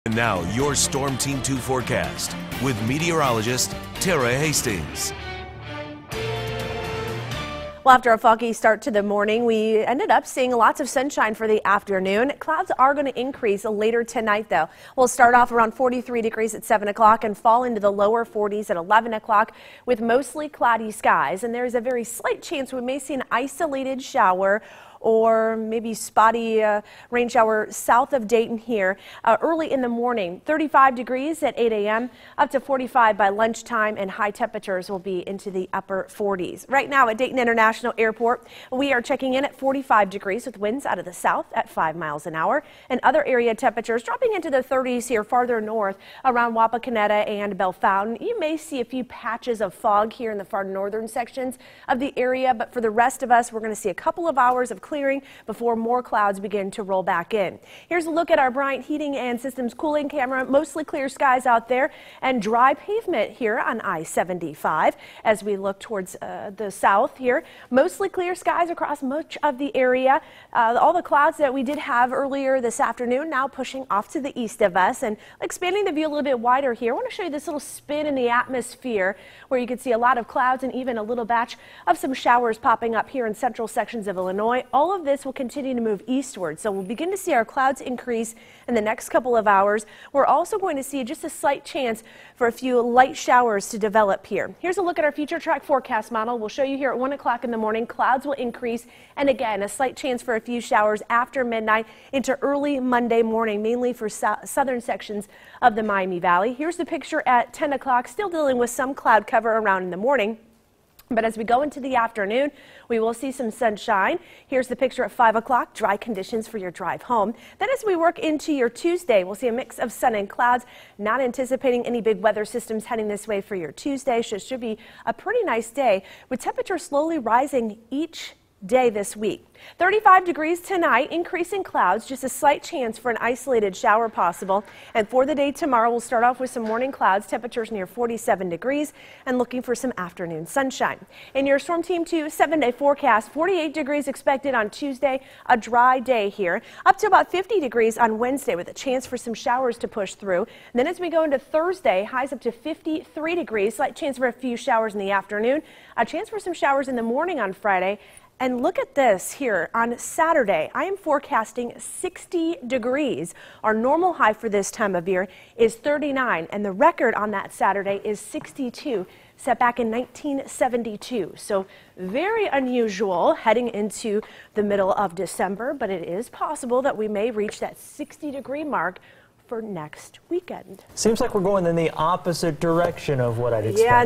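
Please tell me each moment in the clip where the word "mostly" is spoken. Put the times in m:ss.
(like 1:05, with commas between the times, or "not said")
0:20, 1:00, 1:07.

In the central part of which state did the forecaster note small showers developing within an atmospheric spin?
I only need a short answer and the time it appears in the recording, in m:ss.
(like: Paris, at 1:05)
Illinois, at 1:24.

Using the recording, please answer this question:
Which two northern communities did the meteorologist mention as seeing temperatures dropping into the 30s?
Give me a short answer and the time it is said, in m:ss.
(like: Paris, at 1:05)
Wapakoneta and Fountain, at 0:46.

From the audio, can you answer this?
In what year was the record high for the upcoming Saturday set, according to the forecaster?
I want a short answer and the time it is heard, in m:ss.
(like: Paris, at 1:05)
1972, at 2:49.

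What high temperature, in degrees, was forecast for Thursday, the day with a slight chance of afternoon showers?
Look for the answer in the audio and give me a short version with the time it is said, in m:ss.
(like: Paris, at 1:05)
53, at 2:32.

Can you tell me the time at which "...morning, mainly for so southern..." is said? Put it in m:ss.
1:43.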